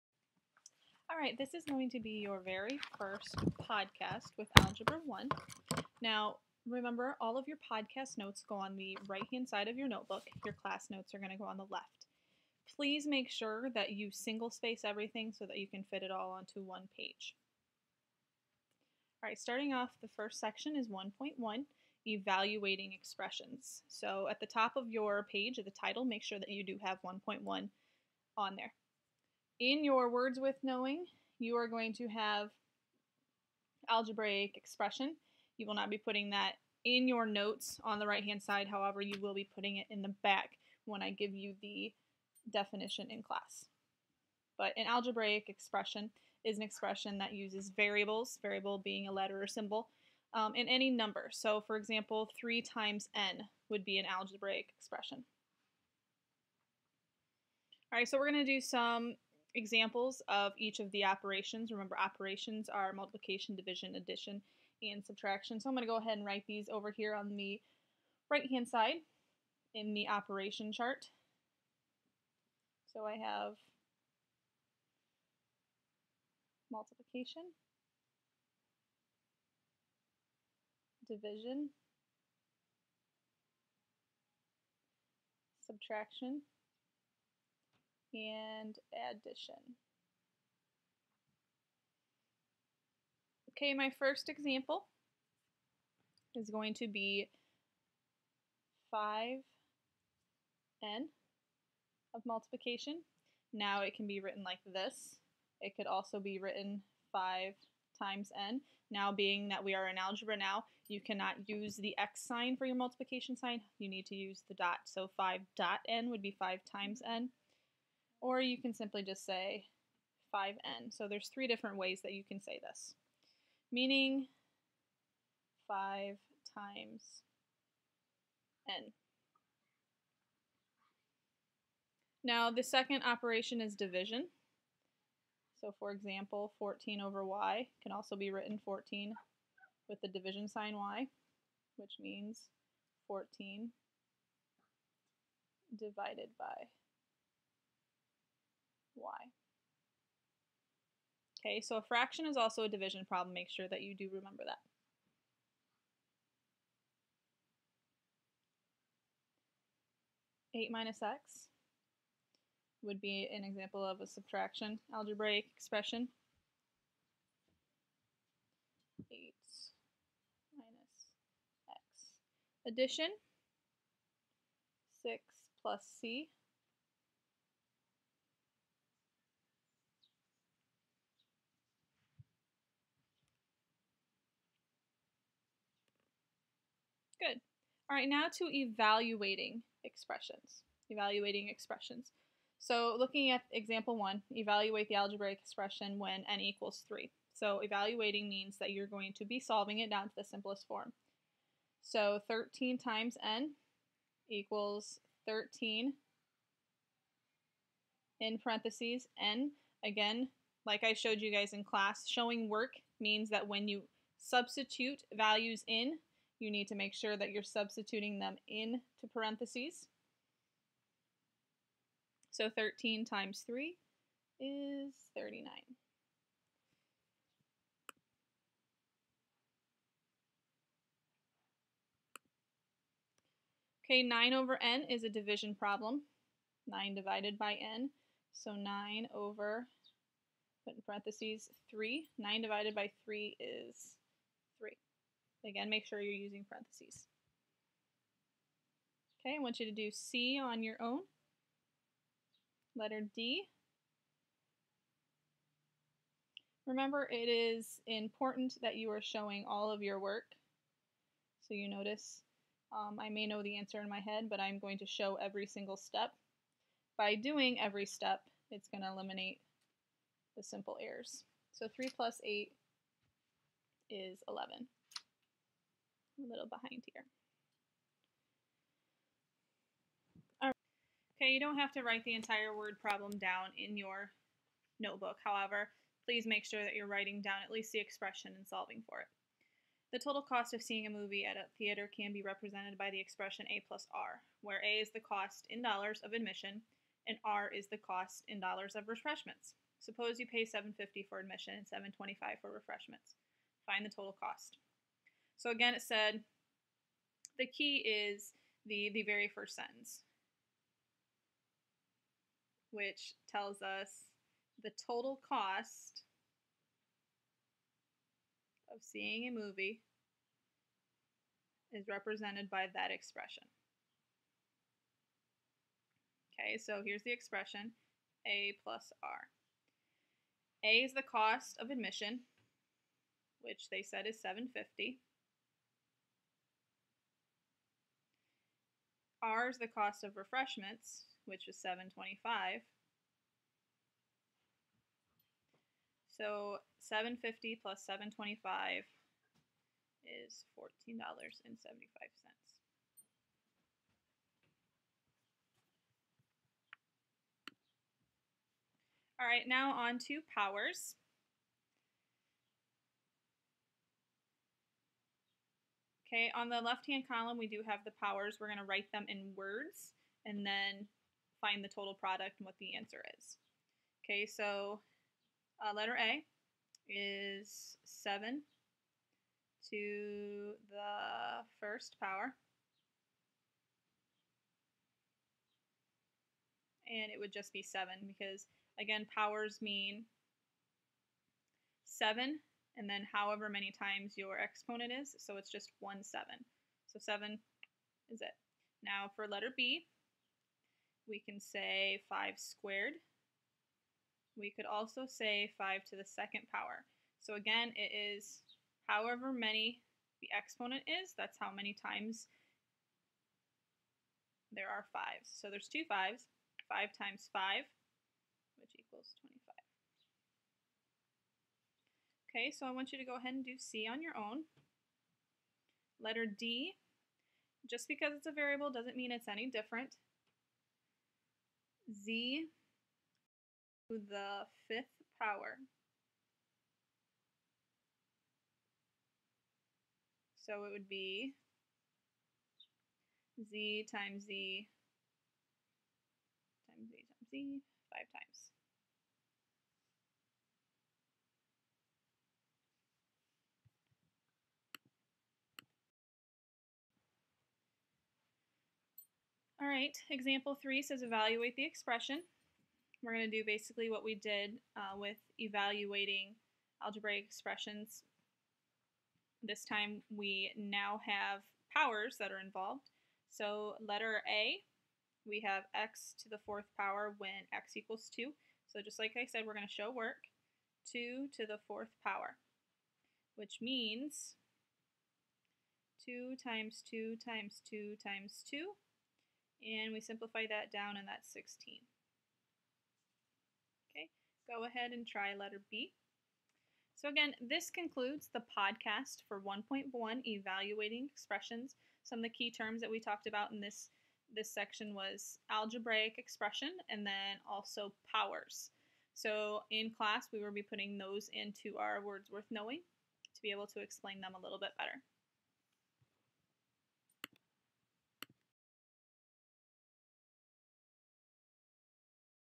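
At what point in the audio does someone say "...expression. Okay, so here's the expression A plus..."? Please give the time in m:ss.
5:22.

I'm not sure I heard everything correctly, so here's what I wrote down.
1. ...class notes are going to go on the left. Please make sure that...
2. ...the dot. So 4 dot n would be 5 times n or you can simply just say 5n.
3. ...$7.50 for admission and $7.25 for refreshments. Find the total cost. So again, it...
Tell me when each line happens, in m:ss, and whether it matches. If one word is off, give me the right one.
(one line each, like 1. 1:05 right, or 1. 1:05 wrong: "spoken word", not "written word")
1. 0:10 right
2. 1:54 wrong: "5", not "4"
3. 5:00 right.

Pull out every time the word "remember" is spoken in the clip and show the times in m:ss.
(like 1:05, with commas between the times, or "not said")
0:06, 1:01, 2:34, 4:16.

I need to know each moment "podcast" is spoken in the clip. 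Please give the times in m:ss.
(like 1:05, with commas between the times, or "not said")
0:03, 0:07, 8:18.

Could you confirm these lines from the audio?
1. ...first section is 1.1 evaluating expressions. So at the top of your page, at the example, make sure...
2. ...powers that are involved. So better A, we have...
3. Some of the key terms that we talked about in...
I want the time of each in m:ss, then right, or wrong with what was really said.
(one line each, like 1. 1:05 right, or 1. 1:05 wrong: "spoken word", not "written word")
1. 0:20 wrong: "title", not "example"
2. 7:51 wrong: "letter", not "better"
3. 8:22 right.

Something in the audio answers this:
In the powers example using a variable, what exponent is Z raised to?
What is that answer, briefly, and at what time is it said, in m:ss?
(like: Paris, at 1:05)
fifth power, at 7:14.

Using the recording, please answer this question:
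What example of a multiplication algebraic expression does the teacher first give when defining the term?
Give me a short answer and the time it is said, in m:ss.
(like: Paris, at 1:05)
3 times n, at 0:52.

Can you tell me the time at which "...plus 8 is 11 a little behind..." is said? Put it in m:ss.
4:31.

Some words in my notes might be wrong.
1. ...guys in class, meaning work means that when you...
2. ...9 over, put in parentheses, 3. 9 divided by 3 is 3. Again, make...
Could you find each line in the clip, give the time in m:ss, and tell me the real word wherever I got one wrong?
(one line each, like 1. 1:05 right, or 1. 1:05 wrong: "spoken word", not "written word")
1. 3:31 wrong: "showing", not "meaning"
2. 3:58 right.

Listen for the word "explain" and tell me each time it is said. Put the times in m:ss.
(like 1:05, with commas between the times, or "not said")
8:33.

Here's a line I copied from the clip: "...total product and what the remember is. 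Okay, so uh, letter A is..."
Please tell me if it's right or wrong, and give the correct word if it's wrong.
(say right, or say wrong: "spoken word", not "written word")
wrong: "answer", not "remember".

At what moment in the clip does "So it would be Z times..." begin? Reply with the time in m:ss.
7:20.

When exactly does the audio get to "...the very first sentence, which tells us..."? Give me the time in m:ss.
5:08.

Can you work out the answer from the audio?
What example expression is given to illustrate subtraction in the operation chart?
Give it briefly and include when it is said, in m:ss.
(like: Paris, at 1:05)
8 minus x, at 2:40.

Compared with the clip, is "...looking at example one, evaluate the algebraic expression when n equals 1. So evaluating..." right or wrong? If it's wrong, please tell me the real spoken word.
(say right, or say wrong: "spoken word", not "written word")
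wrong: "3", not "1".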